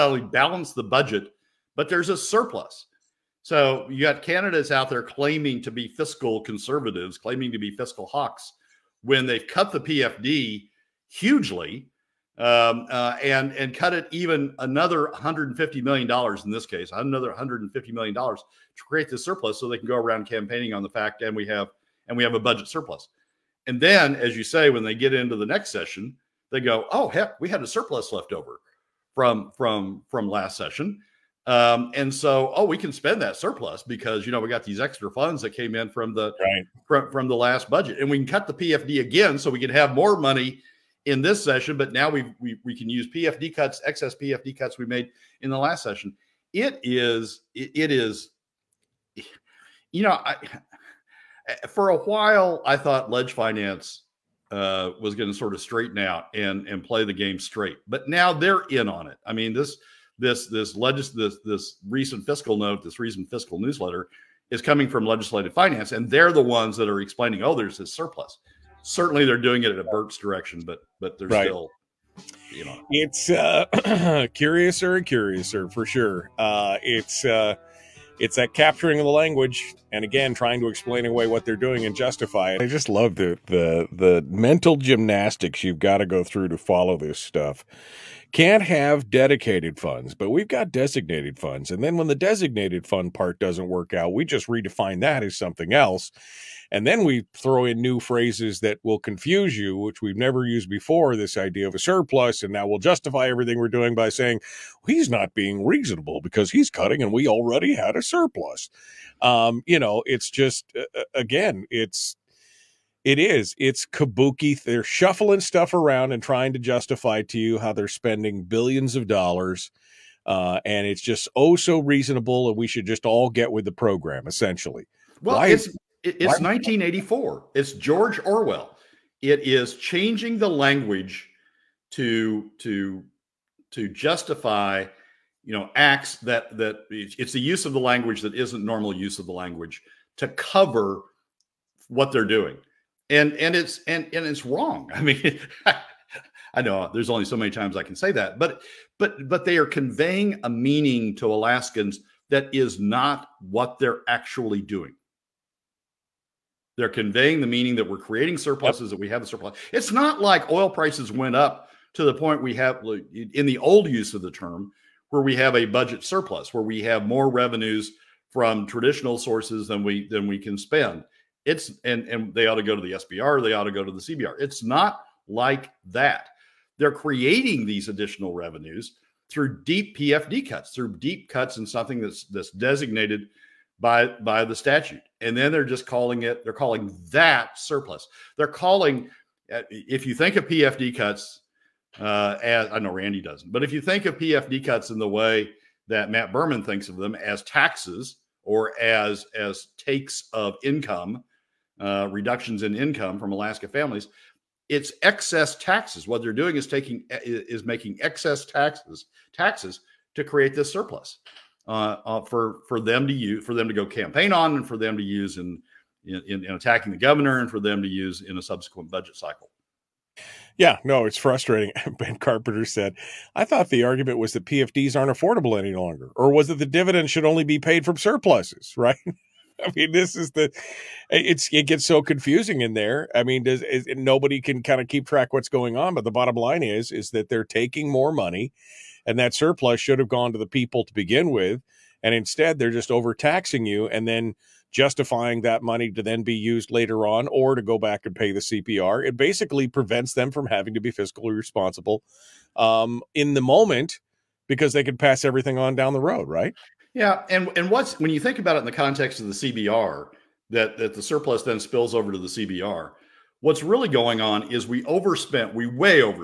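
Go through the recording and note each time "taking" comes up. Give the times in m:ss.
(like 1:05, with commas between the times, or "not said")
3:26, 3:57.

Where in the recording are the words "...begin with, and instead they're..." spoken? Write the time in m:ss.
4:00.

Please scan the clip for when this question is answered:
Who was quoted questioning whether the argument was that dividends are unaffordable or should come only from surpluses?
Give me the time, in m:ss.
3:41.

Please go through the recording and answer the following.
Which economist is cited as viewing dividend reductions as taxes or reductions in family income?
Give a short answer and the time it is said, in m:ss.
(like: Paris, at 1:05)
Matt Berman, at 3:16.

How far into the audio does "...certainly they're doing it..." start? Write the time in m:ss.
1:08.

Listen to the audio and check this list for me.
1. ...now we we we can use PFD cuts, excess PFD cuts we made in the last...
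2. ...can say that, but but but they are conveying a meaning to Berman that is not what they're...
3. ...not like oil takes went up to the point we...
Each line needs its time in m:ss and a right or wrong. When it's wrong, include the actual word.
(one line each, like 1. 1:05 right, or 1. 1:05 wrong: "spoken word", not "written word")
1. 0:41 right
2. 2:27 wrong: "Alaskans", not "Berman"
3. 2:39 wrong: "prices", not "takes".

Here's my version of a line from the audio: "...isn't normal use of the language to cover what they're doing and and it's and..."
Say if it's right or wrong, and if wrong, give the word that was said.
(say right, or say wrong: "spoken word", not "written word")
right.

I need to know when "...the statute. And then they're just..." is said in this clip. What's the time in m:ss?
3:04.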